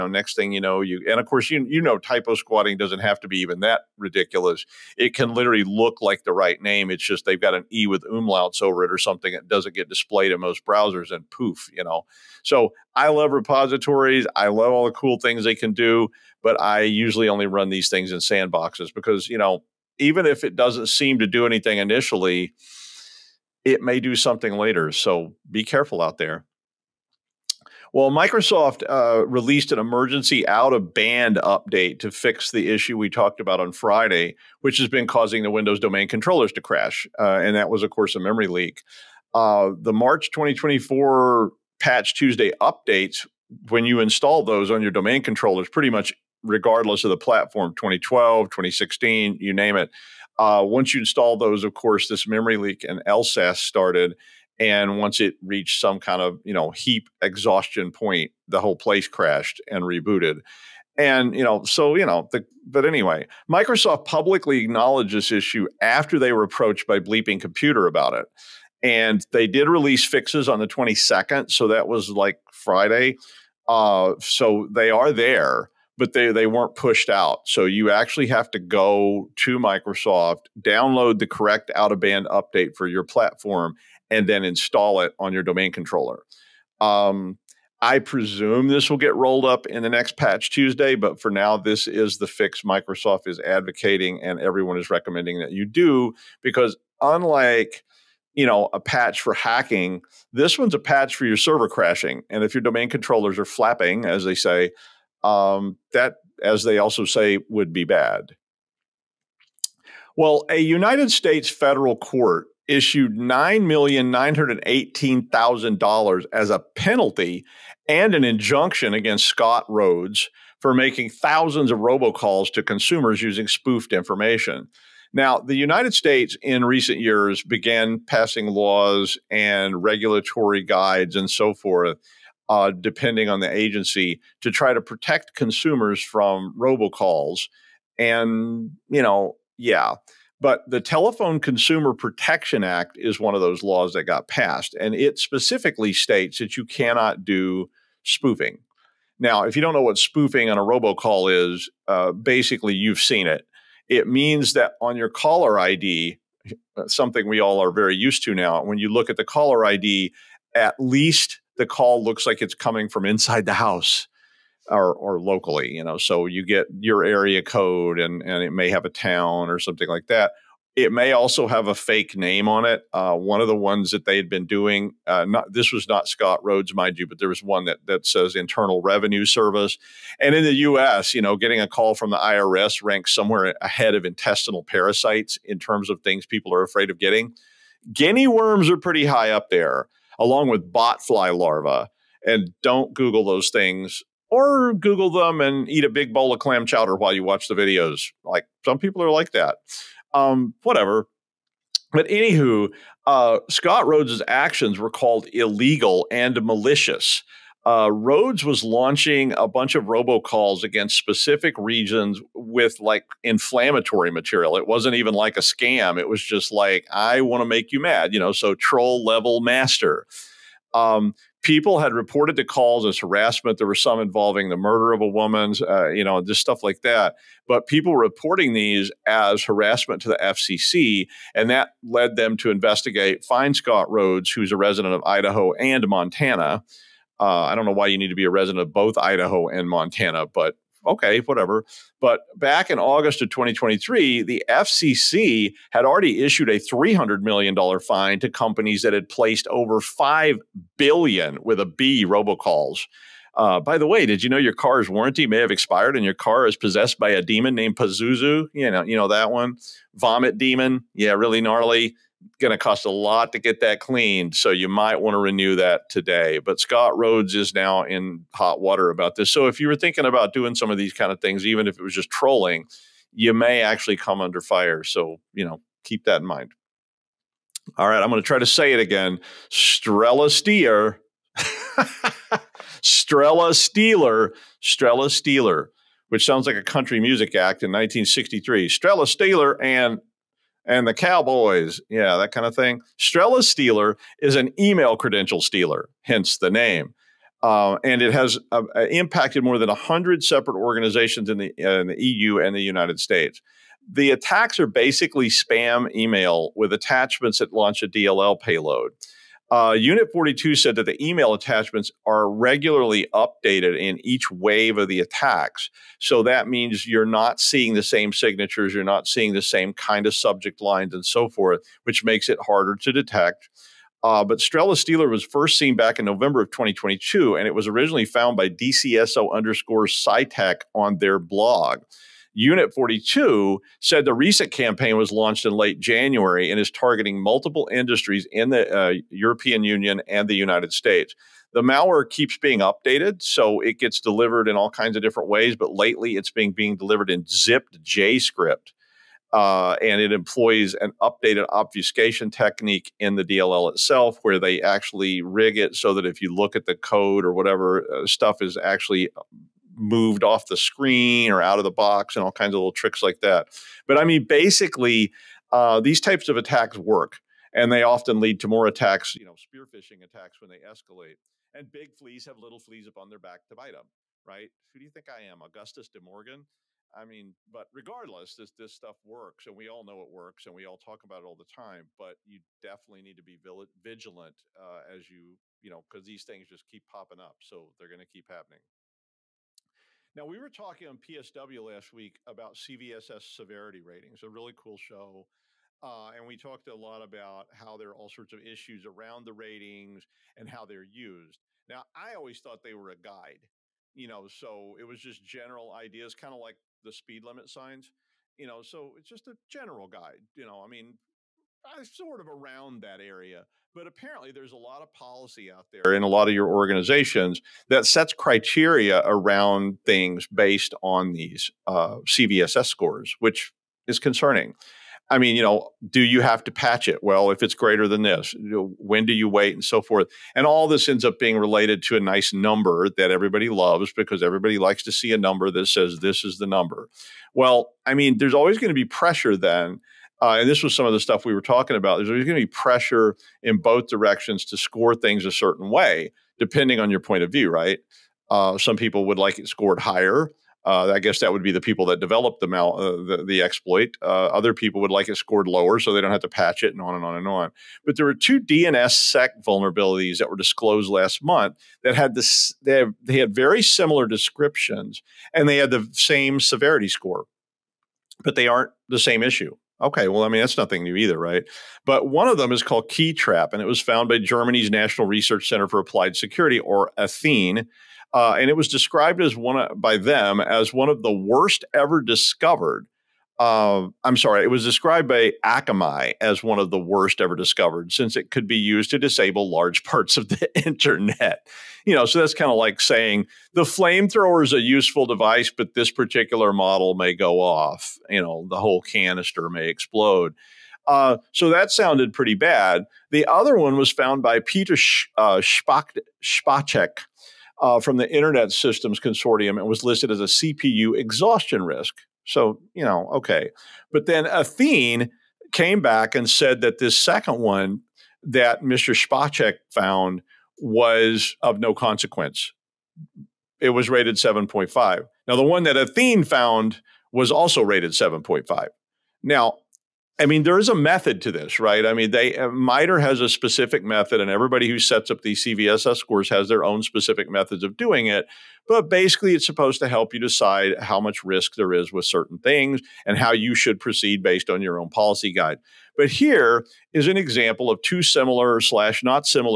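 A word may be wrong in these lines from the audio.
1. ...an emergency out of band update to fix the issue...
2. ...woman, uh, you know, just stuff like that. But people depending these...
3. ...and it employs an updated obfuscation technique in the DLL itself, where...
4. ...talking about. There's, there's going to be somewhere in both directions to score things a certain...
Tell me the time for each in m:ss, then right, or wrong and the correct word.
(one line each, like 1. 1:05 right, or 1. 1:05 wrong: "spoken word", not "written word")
1. 0:29 right
2. 3:45 wrong: "reporting", not "depending"
3. 5:49 right
4. 7:21 wrong: "pressure", not "somewhere".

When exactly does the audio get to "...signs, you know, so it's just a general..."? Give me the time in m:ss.
6:47.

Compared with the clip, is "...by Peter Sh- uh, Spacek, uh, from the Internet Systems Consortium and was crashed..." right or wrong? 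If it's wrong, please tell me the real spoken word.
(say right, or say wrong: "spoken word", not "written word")
wrong: "listed", not "crashed".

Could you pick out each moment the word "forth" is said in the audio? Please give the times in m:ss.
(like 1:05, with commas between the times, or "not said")
2:11, 5:21, 7:09.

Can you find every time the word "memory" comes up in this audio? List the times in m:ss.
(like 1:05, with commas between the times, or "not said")
0:38, 0:52.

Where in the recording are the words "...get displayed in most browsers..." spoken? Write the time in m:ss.
0:09.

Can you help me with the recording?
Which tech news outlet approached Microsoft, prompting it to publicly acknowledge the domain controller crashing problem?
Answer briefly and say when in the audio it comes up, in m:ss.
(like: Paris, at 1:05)
Bleeping Computer, at 1:06.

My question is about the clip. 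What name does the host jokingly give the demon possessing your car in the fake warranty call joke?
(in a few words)
Pazuzu.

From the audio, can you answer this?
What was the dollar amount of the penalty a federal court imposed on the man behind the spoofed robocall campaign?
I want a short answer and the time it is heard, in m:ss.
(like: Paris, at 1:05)
$9,918,000, at 1:53.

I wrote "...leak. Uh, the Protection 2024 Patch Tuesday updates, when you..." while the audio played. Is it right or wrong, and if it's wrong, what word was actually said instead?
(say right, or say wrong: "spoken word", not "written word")
wrong: "March", not "Protection".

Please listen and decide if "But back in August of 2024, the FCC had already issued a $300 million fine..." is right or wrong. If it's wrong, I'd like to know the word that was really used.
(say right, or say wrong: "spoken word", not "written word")
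wrong: "2023", not "2024".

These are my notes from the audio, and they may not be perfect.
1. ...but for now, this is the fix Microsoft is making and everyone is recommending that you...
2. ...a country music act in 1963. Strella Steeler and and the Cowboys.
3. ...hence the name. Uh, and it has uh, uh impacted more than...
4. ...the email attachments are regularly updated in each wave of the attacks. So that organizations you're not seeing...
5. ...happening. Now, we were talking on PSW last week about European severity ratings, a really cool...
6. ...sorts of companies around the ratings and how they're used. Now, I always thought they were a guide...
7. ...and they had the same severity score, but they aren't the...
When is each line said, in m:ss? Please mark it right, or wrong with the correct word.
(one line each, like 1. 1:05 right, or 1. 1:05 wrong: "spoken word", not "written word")
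1. 1:30 wrong: "advocating", not "making"
2. 4:46 right
3. 4:56 right
4. 5:10 wrong: "means", not "organizations"
5. 6:28 wrong: "CVSS", not "European"
6. 6:38 wrong: "issues", not "companies"
7. 7:45 right.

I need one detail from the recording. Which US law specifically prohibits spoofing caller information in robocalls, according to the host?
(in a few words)
Telephone Consumer Protection Act.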